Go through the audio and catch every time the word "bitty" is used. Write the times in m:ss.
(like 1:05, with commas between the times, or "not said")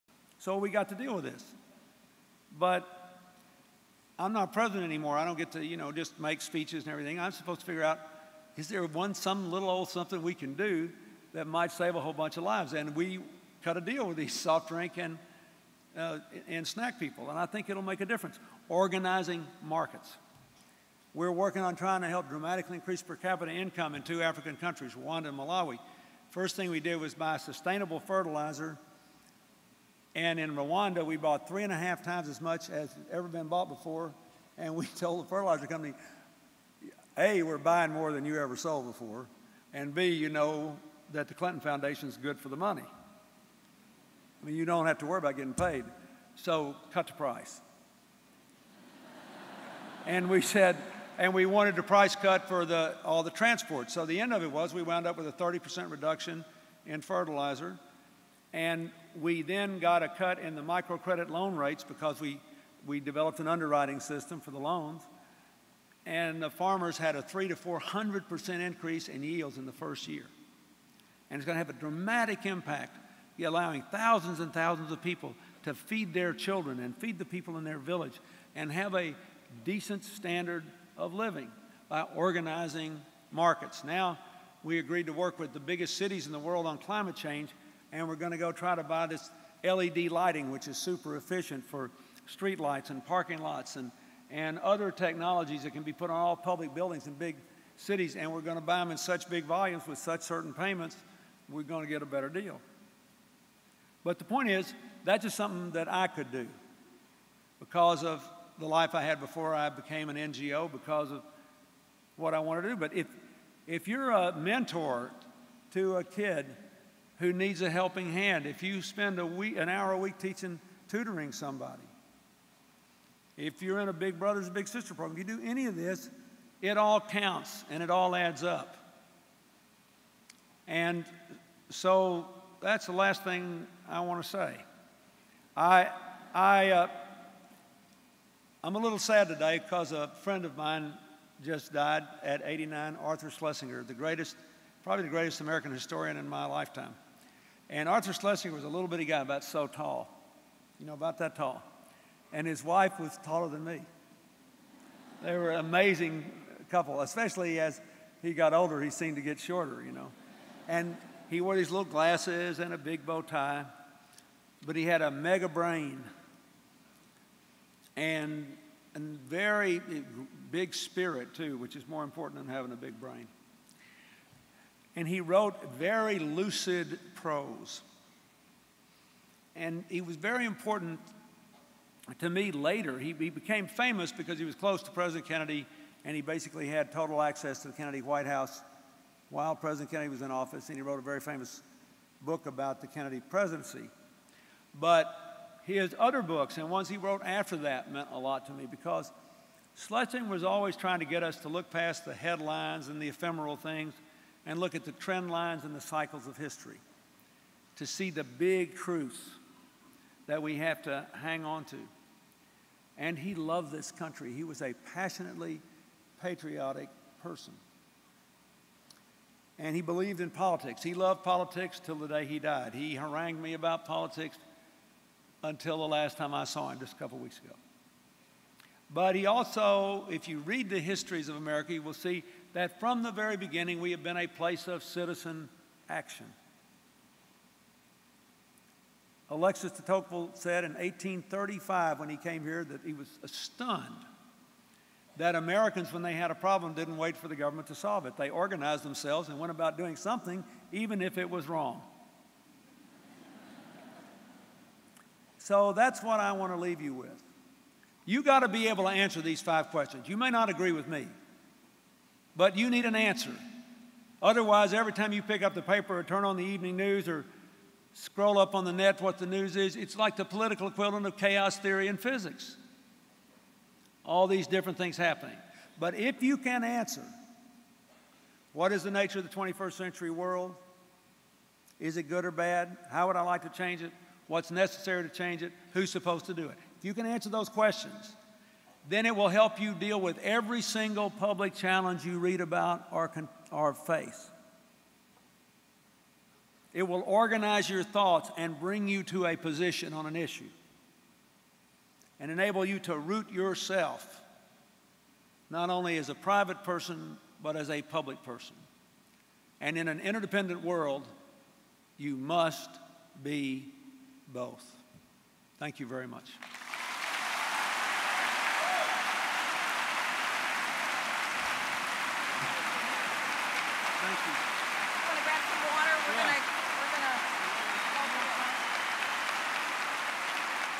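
2:28.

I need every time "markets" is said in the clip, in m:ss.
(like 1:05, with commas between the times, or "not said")
0:19, 1:23.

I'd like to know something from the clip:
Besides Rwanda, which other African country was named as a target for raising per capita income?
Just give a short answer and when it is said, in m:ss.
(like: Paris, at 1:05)
Malawi, at 0:25.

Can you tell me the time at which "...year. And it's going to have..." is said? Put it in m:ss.
1:10.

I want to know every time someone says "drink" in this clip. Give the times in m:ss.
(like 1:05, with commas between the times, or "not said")
0:14.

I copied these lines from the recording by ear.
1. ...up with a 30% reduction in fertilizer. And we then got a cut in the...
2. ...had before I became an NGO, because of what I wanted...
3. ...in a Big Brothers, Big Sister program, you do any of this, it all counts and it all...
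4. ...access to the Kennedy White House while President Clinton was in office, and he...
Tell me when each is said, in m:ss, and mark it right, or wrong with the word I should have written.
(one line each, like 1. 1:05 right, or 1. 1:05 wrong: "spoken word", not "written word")
1. 0:55 right
2. 1:49 right
3. 2:03 right
4. 3:07 wrong: "Kennedy", not "Clinton".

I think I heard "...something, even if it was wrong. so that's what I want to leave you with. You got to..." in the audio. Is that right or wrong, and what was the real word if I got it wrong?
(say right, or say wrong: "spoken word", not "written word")
right.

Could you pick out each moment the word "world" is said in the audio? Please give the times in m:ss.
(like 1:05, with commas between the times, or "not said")
1:26, 4:40, 5:10.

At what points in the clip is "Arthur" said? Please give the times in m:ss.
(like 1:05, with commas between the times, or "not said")
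2:23, 2:27.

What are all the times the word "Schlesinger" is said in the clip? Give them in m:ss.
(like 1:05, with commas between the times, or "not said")
2:23, 2:28, 3:19.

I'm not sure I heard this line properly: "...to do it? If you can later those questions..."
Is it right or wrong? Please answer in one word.
wrong.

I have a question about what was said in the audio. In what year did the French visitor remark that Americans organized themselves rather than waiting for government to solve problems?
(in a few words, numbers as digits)
1835.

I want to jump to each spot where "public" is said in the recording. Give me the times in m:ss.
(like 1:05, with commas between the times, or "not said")
1:36, 4:51, 5:07.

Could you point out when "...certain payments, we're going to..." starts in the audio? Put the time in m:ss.
1:40.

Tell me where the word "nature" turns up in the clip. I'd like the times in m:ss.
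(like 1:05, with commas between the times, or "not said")
4:38.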